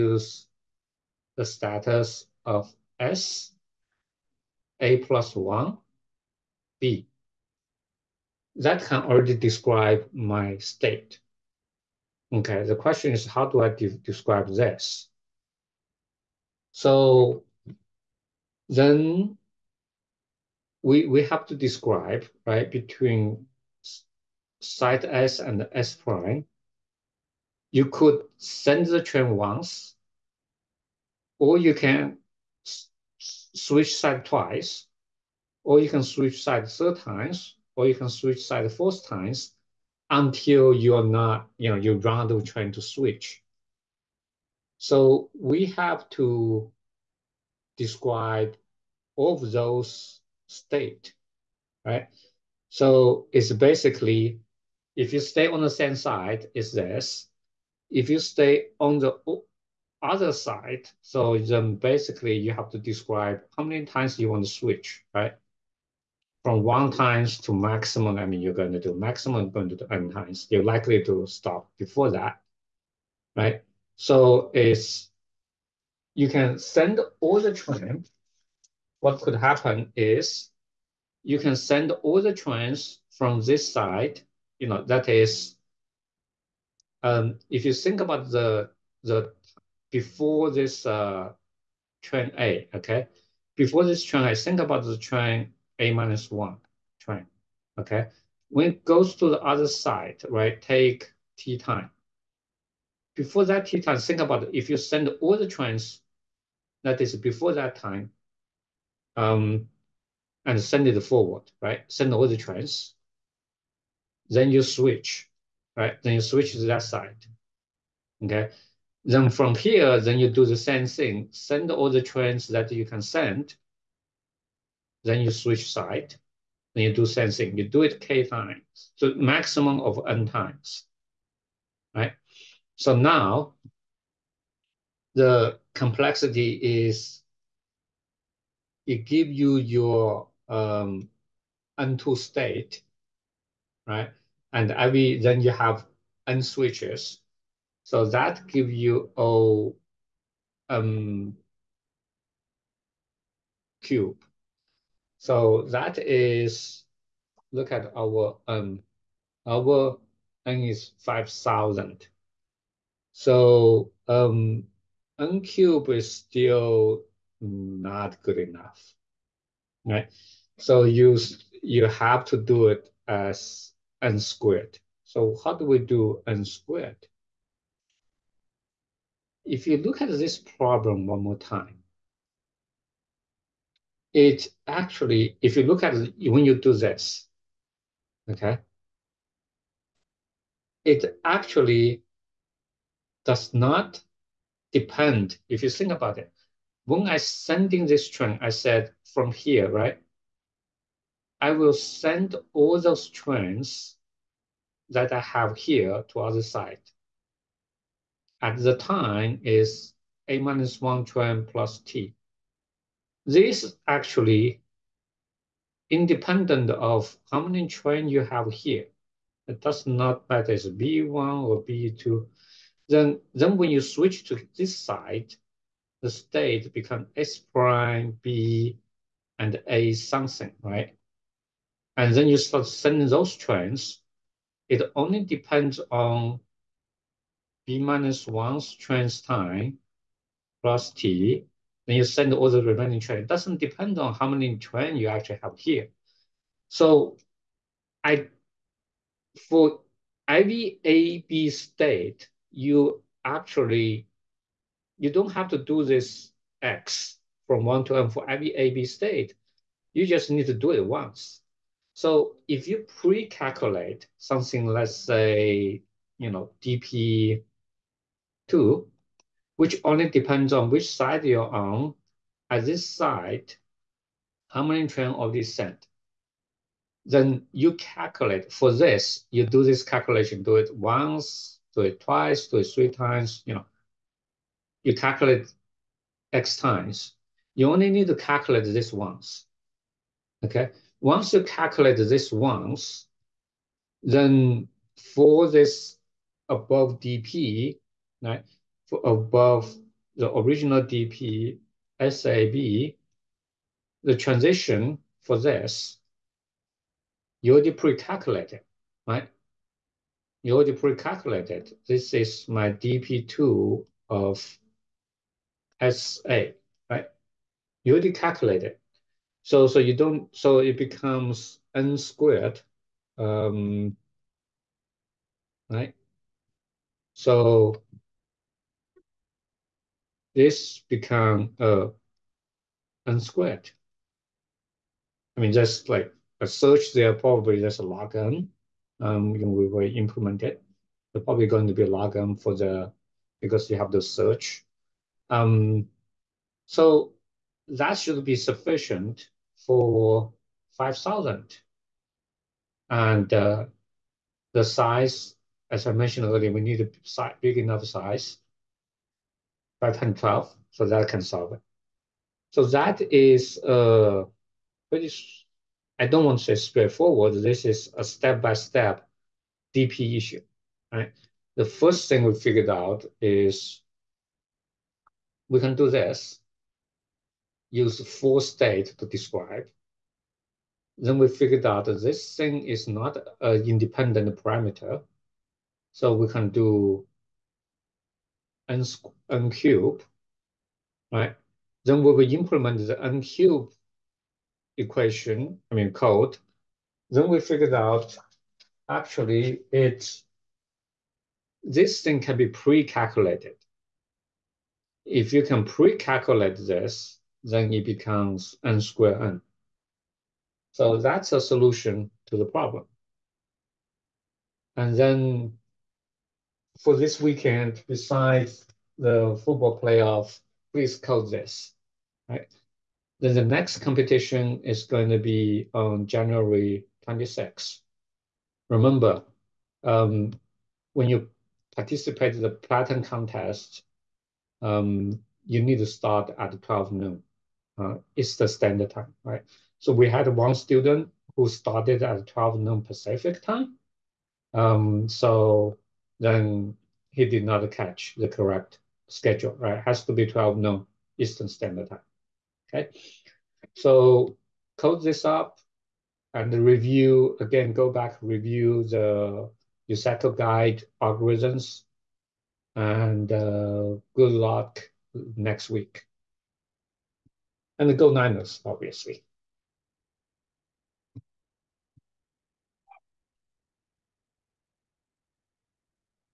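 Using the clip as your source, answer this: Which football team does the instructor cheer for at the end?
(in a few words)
Niners.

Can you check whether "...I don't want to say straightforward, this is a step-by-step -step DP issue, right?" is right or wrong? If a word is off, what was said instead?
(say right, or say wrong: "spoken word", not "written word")
right.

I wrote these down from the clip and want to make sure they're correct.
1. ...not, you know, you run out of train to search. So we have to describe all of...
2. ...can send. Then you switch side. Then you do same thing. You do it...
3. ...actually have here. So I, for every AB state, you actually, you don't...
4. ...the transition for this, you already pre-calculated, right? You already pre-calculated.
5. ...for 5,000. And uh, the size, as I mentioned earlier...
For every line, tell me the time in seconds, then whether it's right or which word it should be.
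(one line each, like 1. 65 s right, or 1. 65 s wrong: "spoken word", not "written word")
1. 41 s wrong: "switch", not "search"
2. 122 s right
3. 245 s right
4. 304 s right
5. 349 s right.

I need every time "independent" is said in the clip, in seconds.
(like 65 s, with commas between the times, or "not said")
215 s, 383 s.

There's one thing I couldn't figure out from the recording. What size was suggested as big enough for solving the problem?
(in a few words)
512.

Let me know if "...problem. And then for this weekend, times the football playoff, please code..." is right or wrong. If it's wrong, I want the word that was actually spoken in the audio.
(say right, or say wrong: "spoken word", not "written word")
wrong: "besides", not "times".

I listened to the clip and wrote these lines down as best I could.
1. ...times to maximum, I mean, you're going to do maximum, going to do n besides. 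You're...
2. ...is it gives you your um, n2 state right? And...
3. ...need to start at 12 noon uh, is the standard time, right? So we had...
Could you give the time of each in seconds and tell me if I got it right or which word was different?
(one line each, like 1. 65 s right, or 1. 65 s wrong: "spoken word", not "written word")
1. 66 s wrong: "times", not "besides"
2. 136 s right
3. 435 s right.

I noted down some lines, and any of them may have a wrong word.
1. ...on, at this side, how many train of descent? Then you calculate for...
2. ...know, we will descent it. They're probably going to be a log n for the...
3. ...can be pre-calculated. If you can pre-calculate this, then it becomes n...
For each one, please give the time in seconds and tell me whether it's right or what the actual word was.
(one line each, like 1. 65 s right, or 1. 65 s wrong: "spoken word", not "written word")
1. 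271 s right
2. 339 s wrong: "implement", not "descent"
3. 402 s right.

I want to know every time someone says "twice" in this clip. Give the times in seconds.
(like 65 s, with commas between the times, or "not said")
34 s, 281 s.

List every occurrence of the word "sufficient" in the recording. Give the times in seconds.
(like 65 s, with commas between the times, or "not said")
348 s.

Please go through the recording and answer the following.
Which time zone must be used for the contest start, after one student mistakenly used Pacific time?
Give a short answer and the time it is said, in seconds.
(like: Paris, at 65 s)
Eastern Standard Time, at 451 s.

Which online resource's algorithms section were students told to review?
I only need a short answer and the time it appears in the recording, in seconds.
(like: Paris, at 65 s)
USACO guide, at 459 s.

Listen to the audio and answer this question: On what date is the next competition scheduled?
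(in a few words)
January 26.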